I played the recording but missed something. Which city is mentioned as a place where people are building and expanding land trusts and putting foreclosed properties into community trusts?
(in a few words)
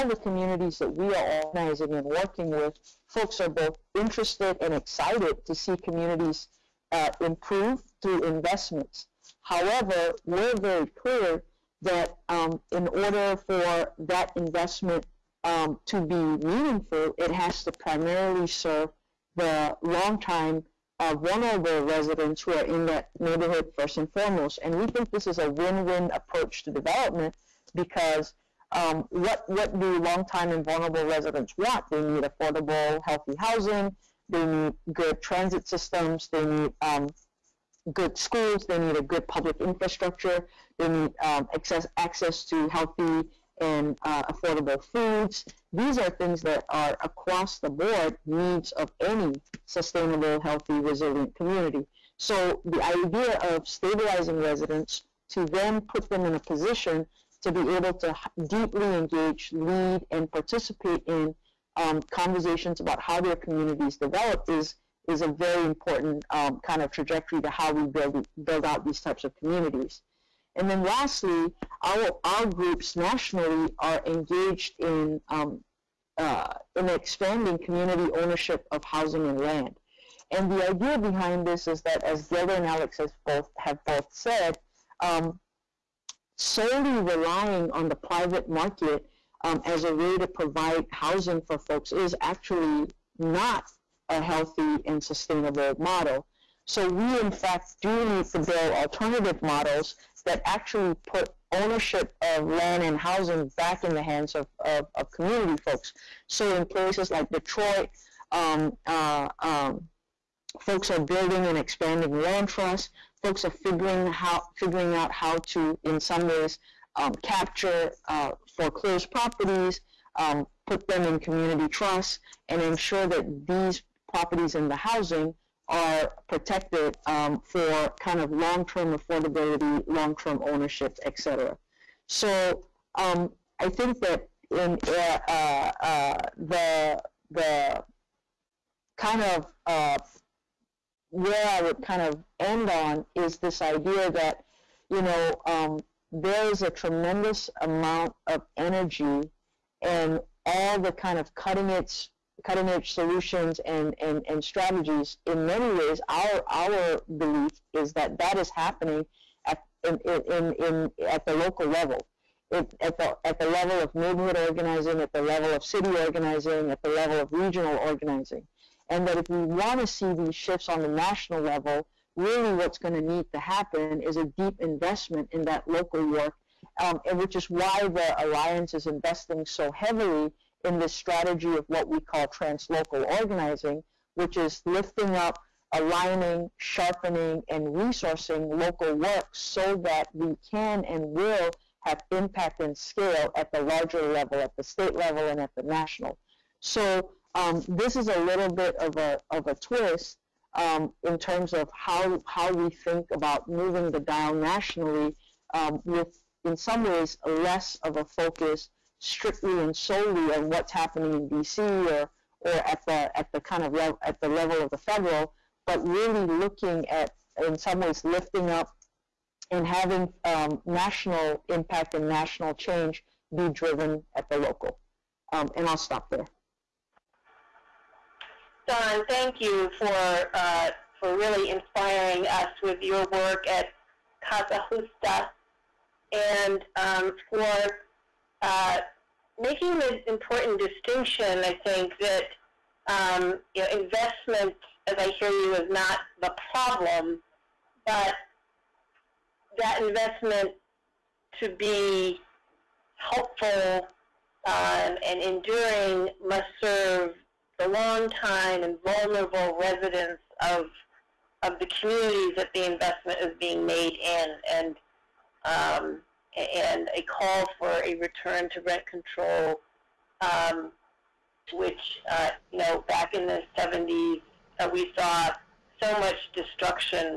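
Detroit.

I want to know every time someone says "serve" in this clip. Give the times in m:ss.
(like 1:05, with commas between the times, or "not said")
0:18, 4:16.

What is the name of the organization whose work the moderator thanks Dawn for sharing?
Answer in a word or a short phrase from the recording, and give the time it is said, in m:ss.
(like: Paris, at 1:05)
Causa Justa, at 3:54.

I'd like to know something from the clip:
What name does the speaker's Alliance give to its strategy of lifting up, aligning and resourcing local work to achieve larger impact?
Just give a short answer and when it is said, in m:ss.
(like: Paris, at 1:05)
translocal organizing, at 3:02.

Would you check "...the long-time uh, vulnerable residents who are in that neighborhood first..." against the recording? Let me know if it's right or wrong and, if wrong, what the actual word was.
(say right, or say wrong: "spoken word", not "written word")
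right.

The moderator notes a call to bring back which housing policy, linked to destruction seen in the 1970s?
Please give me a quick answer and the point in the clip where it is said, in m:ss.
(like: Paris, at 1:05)
rent control, at 4:28.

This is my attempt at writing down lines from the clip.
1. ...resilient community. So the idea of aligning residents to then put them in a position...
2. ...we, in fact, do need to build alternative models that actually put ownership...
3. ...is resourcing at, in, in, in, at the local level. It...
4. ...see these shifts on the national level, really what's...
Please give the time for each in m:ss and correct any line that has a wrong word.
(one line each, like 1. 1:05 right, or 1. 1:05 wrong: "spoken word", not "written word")
1. 0:50 wrong: "stabilizing", not "aligning"
2. 1:36 right
3. 2:38 wrong: "happening", not "resourcing"
4. 2:49 right.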